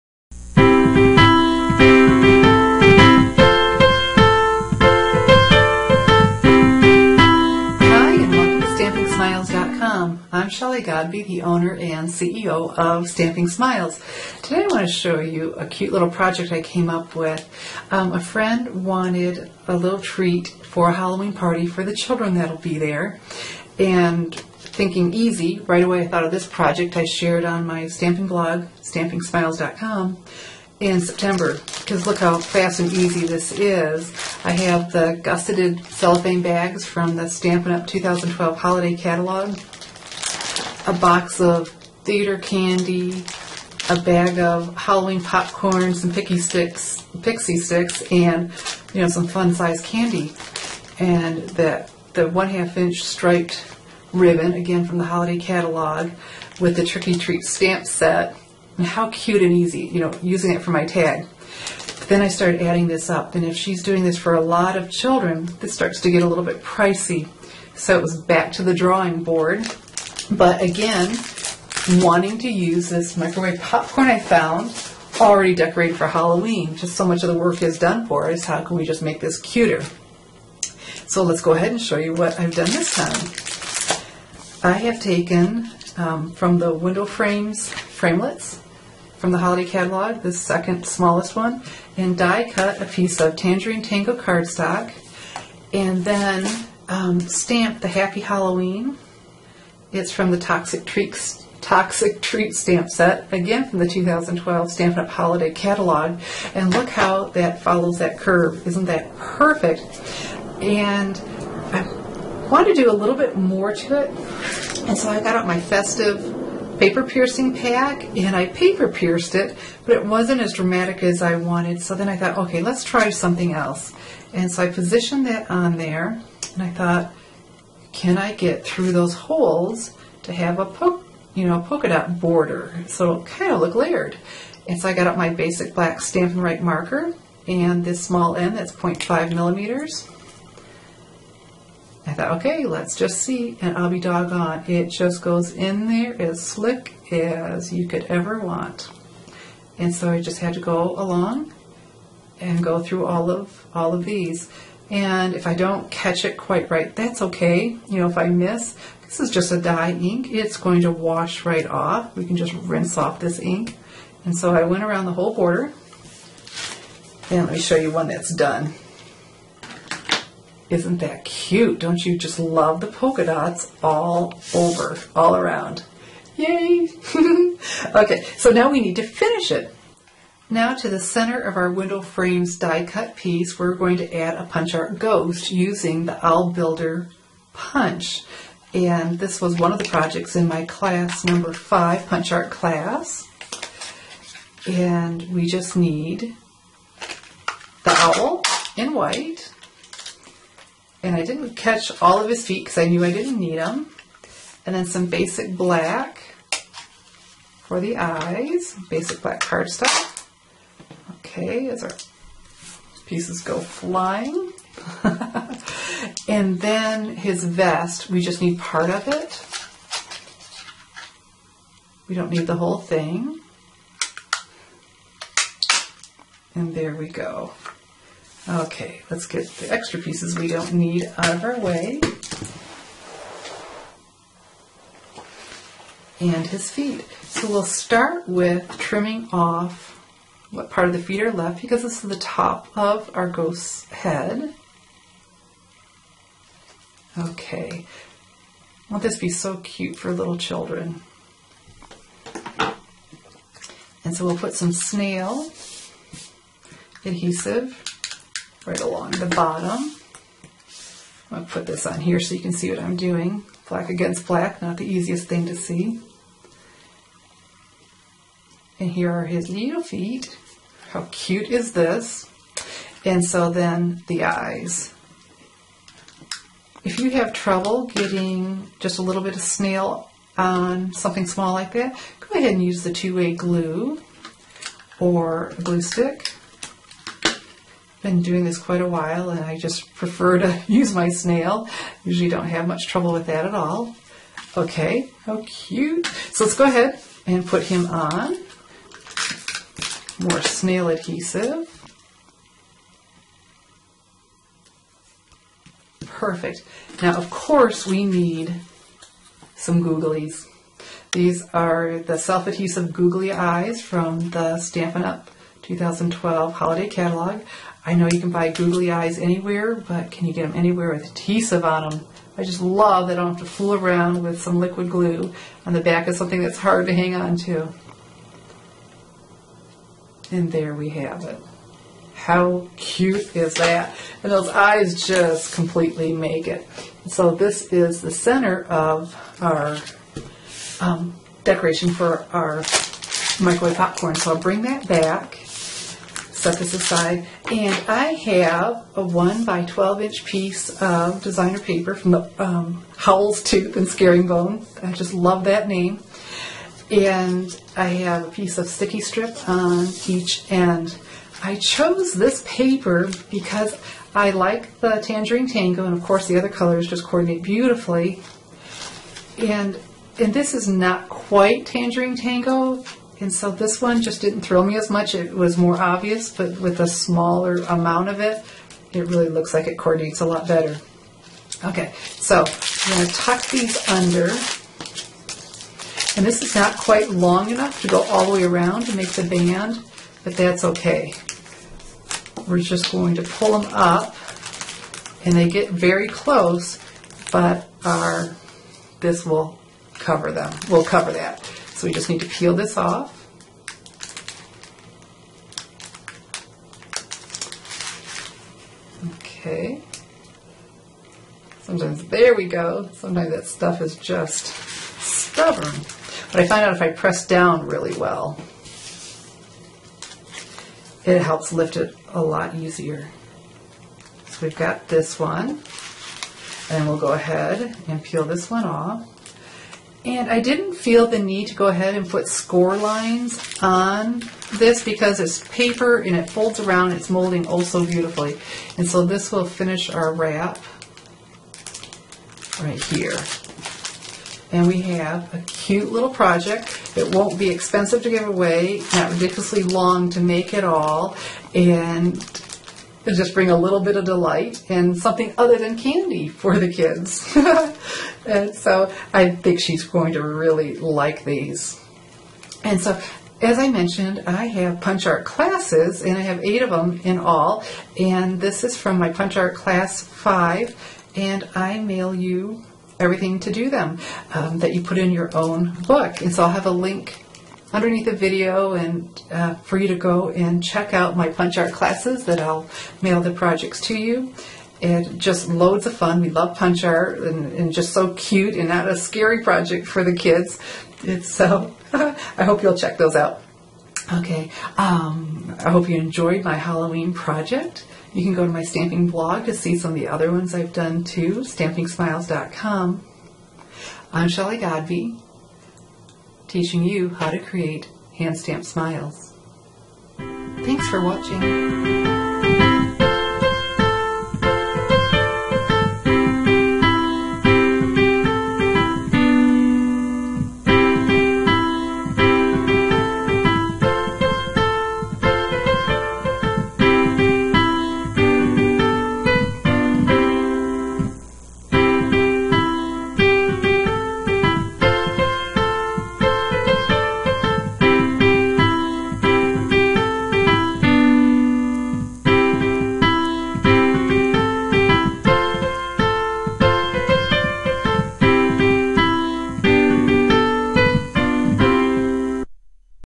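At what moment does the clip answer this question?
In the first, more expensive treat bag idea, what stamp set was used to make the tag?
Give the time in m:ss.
0:56.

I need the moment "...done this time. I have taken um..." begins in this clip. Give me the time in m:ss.
1:22.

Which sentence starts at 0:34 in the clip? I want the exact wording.
I have the gusseted cellophane bags from the Stampin' Up!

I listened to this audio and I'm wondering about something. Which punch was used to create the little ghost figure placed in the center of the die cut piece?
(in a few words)
Owl Builder punch.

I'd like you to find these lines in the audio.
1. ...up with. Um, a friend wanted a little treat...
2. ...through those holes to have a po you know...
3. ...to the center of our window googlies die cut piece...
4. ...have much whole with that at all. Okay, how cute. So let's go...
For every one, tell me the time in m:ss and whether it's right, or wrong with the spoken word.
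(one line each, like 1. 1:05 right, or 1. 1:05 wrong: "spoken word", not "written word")
1. 0:16 right
2. 2:08 right
3. 3:00 wrong: "frames", not "googlies"
4. 4:52 wrong: "trouble", not "whole".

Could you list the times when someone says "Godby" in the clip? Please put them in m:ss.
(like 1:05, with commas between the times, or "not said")
0:10, 8:24.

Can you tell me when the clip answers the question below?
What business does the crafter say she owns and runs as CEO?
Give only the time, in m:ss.
0:13.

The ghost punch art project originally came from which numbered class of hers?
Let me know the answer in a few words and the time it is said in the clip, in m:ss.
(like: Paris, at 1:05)
class number five, at 3:10.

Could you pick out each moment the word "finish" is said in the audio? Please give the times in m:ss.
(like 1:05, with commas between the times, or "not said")
2:59, 7:19.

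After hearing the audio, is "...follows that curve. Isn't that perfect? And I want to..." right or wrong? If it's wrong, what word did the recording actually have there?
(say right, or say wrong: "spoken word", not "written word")
right.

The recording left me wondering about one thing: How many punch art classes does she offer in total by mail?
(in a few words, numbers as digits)
8.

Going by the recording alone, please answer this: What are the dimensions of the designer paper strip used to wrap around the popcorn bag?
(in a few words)
1 by 12 inch.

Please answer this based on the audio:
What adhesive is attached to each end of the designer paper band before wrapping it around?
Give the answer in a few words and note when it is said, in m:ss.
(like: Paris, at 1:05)
sticky strip, at 5:58.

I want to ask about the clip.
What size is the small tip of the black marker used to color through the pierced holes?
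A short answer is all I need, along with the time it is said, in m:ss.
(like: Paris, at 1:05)
0.5 millimeters, at 2:18.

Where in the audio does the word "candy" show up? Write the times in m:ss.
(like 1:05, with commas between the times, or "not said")
0:42, 0:49, 7:35.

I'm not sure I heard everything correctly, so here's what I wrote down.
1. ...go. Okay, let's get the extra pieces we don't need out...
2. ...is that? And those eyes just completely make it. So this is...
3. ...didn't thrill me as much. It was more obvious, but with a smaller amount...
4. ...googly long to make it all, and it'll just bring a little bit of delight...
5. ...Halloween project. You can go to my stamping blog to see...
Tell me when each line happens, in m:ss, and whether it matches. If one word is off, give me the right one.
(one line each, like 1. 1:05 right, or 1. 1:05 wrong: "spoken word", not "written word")
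1. 3:47 right
2. 5:33 right
3. 6:14 right
4. 7:29 wrong: "ridiculously", not "googly"
5. 8:16 right.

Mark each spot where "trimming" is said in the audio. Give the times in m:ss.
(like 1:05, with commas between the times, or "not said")
3:58.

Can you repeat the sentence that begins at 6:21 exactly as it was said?
Okay, so I'm going to tuck these under.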